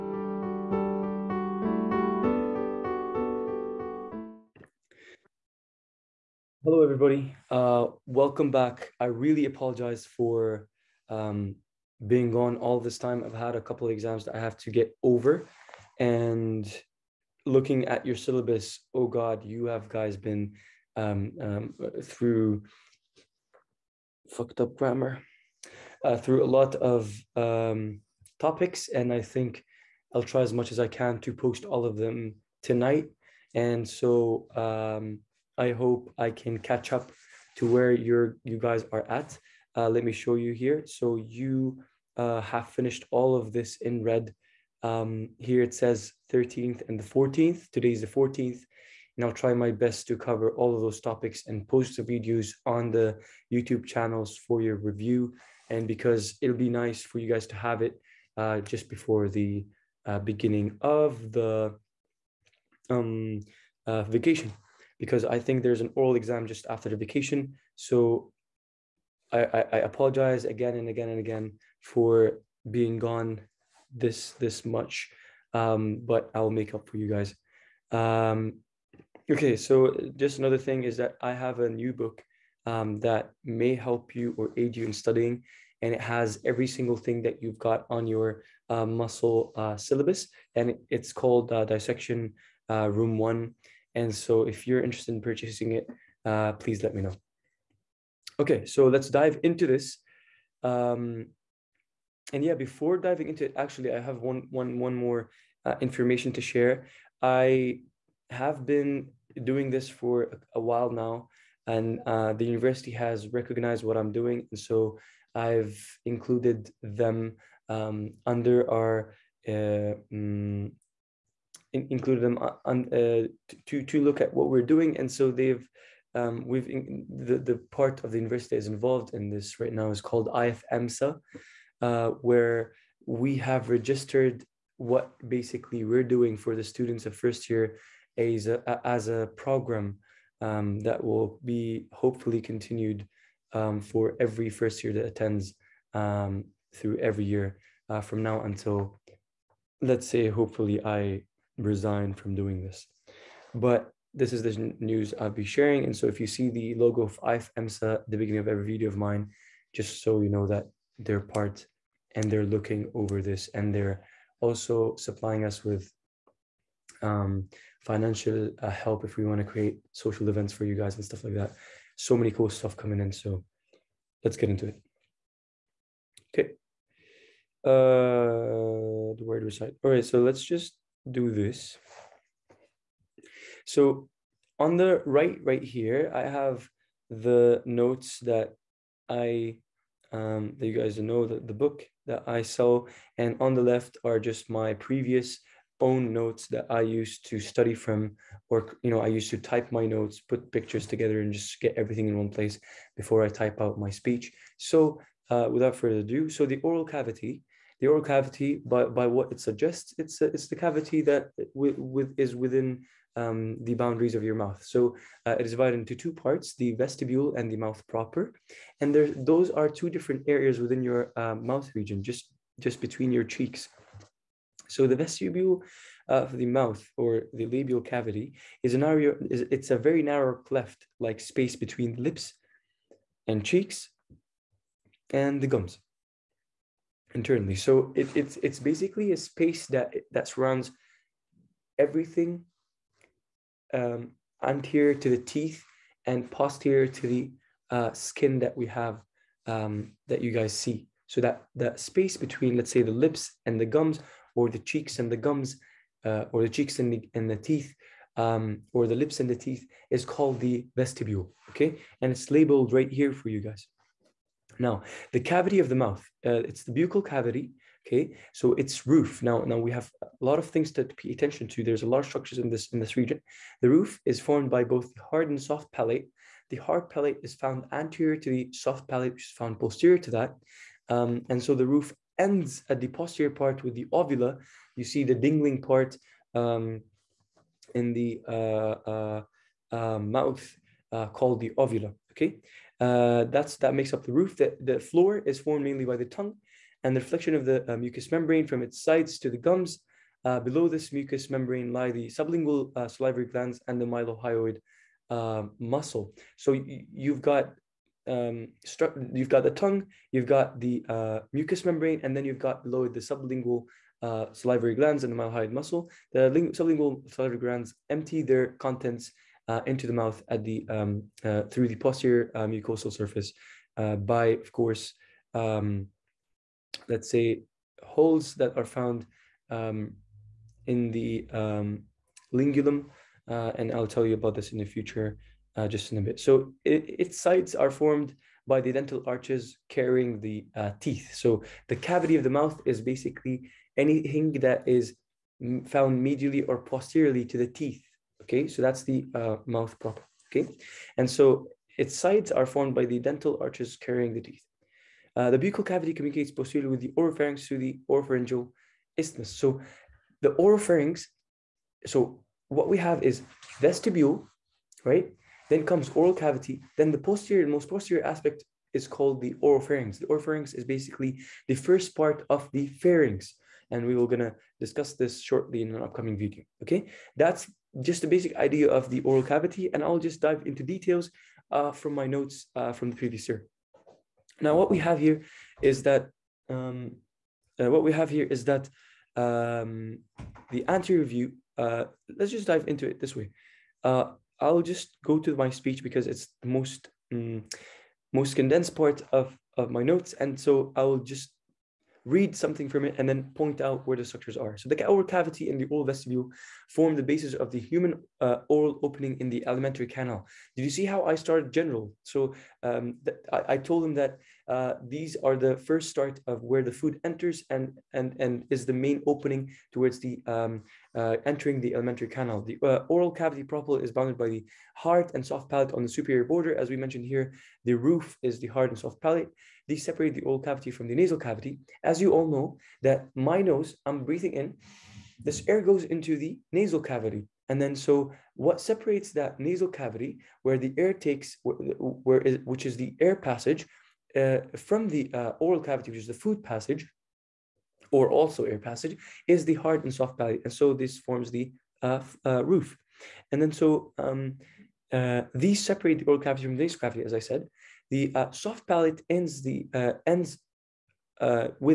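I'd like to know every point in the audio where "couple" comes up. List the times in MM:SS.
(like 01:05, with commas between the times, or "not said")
00:13.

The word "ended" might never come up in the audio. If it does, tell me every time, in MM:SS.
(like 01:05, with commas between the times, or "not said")
not said.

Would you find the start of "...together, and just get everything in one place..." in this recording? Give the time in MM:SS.
03:20.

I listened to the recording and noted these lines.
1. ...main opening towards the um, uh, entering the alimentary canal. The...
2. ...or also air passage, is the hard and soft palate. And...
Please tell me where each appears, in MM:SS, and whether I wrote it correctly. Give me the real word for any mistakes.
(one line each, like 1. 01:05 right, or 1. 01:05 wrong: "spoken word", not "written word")
1. 06:58 right
2. 07:27 right.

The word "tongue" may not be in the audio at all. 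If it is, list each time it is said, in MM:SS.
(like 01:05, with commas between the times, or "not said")
04:56, 05:09.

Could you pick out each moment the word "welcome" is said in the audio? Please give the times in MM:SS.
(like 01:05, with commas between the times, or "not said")
00:08.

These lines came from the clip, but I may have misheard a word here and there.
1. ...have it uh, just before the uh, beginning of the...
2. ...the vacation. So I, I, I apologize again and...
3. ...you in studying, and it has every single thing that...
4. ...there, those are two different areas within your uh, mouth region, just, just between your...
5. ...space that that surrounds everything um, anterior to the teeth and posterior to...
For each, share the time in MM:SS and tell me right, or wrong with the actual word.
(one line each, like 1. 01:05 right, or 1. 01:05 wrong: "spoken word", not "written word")
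1. 00:57 right
2. 01:06 right
3. 01:24 right
4. 03:38 right
5. 03:59 right.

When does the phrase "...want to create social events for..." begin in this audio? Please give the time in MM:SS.
02:49.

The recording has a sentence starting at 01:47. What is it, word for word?
I have been doing this for a while now, and uh, the university has recognized what I'm doing.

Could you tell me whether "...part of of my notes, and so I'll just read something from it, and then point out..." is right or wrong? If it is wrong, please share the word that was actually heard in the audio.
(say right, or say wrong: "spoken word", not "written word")
right.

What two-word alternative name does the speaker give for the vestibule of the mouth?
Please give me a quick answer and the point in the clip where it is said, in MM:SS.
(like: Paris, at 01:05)
labial cavity, at 03:47.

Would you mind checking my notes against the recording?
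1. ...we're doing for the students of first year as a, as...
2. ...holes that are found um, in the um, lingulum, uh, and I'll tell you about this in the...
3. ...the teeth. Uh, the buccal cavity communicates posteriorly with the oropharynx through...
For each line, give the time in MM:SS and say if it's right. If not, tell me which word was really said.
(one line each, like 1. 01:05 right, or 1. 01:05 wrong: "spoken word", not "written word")
1. 02:15 right
2. 05:27 right
3. 05:54 right.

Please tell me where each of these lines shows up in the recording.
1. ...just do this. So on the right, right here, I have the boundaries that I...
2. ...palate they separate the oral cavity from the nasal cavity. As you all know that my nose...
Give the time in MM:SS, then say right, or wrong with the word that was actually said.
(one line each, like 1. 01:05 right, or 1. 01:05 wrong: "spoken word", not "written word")
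1. 03:00 wrong: "notes", not "boundaries"
2. 07:09 right.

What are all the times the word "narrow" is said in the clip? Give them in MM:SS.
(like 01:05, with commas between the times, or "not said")
03:50.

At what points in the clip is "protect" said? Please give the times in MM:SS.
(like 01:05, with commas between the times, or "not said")
not said.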